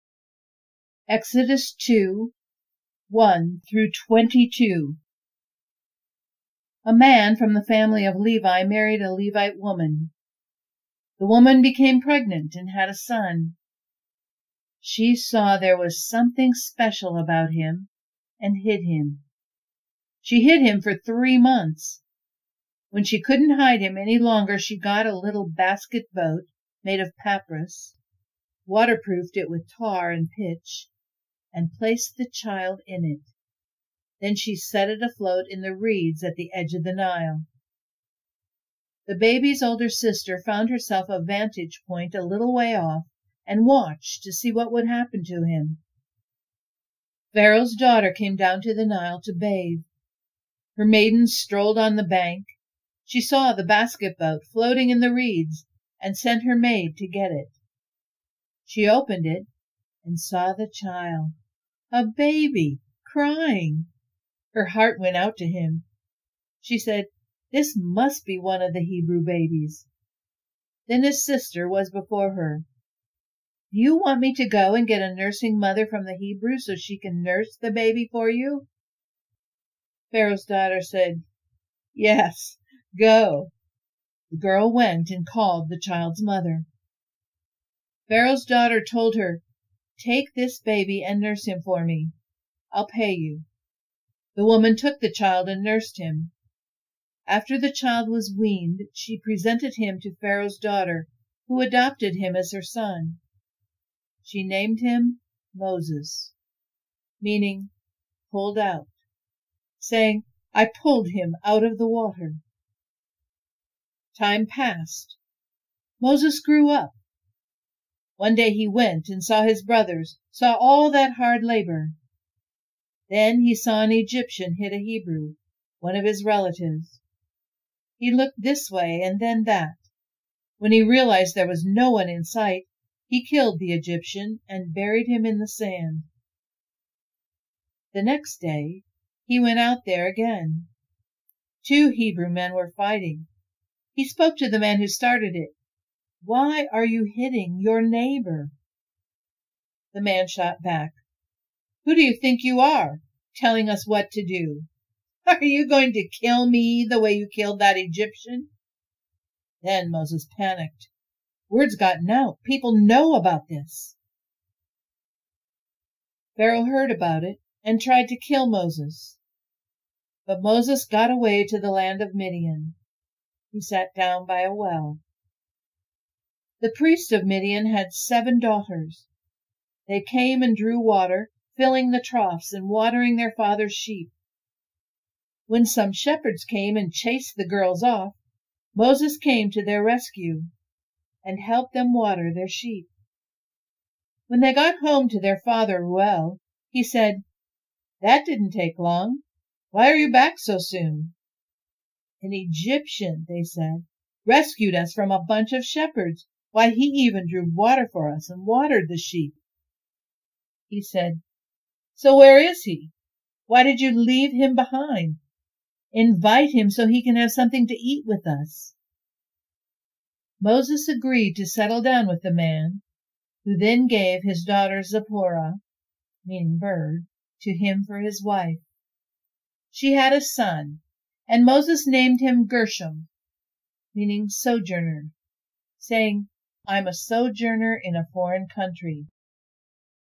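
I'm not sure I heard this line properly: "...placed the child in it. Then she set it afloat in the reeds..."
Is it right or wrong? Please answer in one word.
right.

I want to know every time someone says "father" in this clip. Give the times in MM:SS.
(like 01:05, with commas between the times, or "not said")
03:03, 03:15.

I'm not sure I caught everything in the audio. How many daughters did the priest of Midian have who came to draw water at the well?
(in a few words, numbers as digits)
7.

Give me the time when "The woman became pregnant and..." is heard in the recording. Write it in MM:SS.
00:11.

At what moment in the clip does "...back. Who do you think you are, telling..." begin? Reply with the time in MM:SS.
02:30.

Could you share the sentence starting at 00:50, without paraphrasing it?
Her maidens strolled on the bank.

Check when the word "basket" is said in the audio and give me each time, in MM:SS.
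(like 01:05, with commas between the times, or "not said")
00:25, 00:53.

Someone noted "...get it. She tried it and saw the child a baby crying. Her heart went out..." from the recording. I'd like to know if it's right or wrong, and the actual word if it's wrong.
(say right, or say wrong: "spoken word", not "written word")
wrong: "opened", not "tried".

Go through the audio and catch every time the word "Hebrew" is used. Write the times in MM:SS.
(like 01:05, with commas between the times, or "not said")
01:08, 01:16, 02:04, 02:21.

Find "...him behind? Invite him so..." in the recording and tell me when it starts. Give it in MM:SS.
03:34.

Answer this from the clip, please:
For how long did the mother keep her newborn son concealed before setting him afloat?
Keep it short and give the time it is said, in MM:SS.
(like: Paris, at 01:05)
3 months, at 00:20.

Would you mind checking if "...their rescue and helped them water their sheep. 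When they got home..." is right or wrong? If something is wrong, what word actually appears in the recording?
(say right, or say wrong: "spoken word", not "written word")
right.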